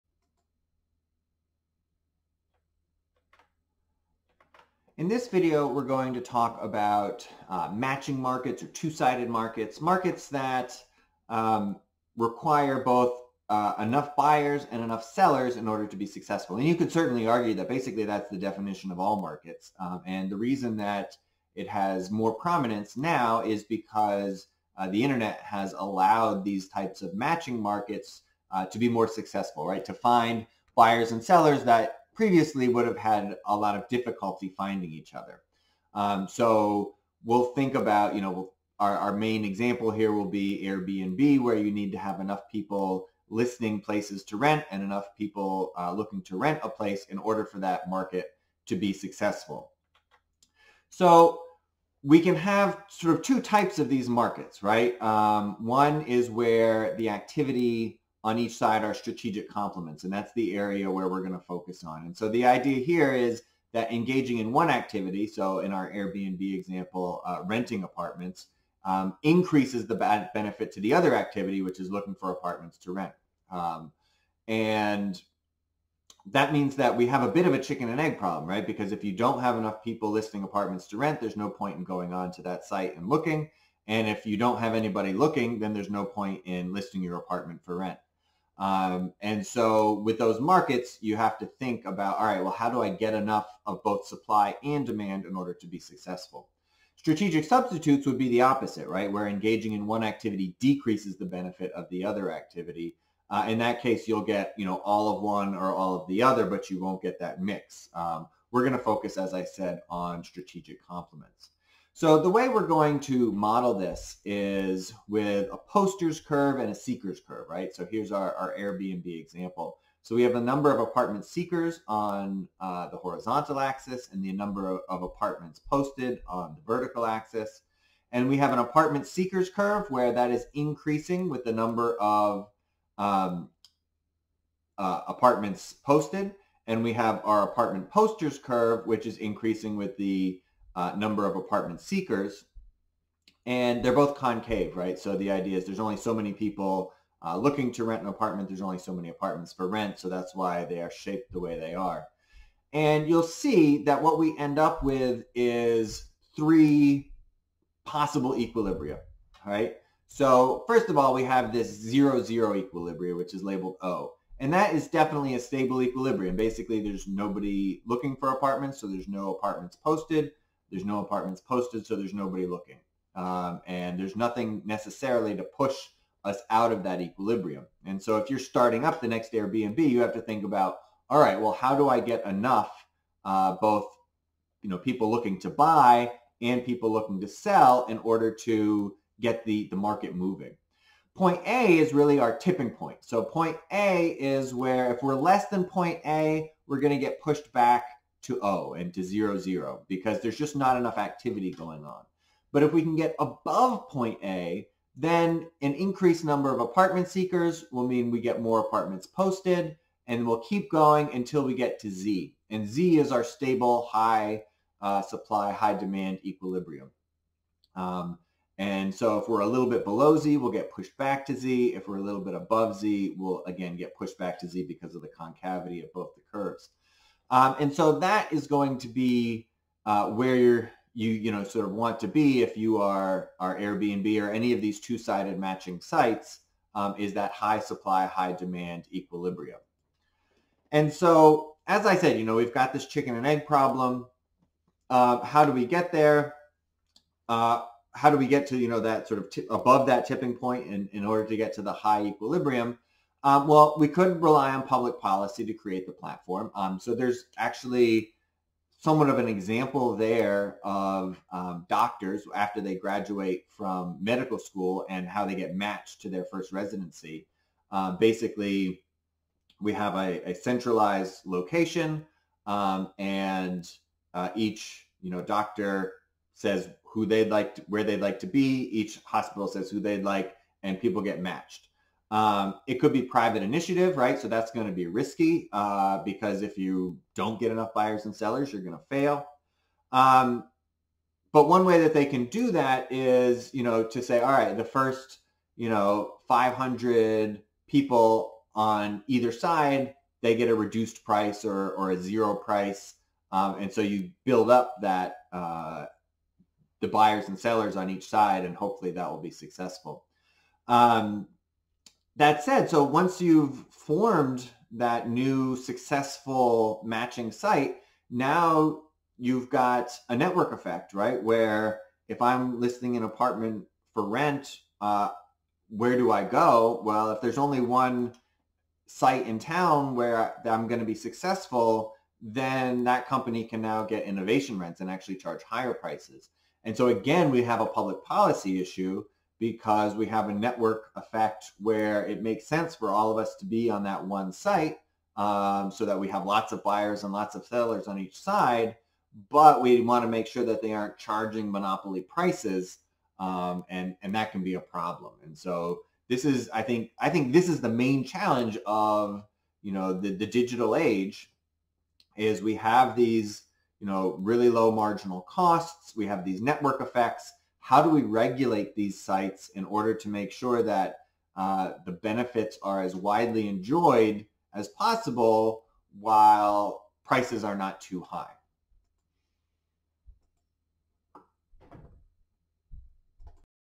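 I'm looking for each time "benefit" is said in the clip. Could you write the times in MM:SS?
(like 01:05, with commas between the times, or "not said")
01:10, 01:41, 06:11.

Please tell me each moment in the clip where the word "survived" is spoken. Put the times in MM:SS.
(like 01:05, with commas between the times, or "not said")
not said.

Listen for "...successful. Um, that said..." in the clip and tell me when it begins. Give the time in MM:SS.
05:09.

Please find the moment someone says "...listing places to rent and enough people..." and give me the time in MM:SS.
00:43.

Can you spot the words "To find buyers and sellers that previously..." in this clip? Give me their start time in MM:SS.
00:29.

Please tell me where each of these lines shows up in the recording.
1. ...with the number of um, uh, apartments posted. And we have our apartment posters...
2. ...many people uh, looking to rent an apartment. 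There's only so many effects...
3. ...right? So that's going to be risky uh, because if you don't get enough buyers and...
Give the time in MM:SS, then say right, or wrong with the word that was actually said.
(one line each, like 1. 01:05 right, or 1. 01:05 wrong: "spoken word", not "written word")
1. 02:11 right
2. 02:26 wrong: "apartments", not "effects"
3. 04:43 right.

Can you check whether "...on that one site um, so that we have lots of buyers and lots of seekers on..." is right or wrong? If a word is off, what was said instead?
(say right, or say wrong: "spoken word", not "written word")
wrong: "sellers", not "seekers".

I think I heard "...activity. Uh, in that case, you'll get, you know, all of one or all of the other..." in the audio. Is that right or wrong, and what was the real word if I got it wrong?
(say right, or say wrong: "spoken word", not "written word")
right.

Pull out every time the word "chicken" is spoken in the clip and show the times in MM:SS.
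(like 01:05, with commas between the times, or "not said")
01:17, 04:02.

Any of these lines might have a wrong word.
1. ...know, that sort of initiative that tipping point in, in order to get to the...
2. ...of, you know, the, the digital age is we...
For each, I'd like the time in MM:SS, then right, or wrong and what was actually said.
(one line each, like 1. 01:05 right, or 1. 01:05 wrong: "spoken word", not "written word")
1. 04:08 wrong: "above", not "initiative"
2. 05:58 right.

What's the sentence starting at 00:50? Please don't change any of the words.
So we can have sort of two types of these markets, right?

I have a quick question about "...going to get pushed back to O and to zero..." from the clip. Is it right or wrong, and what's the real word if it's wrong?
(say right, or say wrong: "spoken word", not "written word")
right.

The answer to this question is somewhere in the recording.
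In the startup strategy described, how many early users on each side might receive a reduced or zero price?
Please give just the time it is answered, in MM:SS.
04:56.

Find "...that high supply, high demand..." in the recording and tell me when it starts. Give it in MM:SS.
03:57.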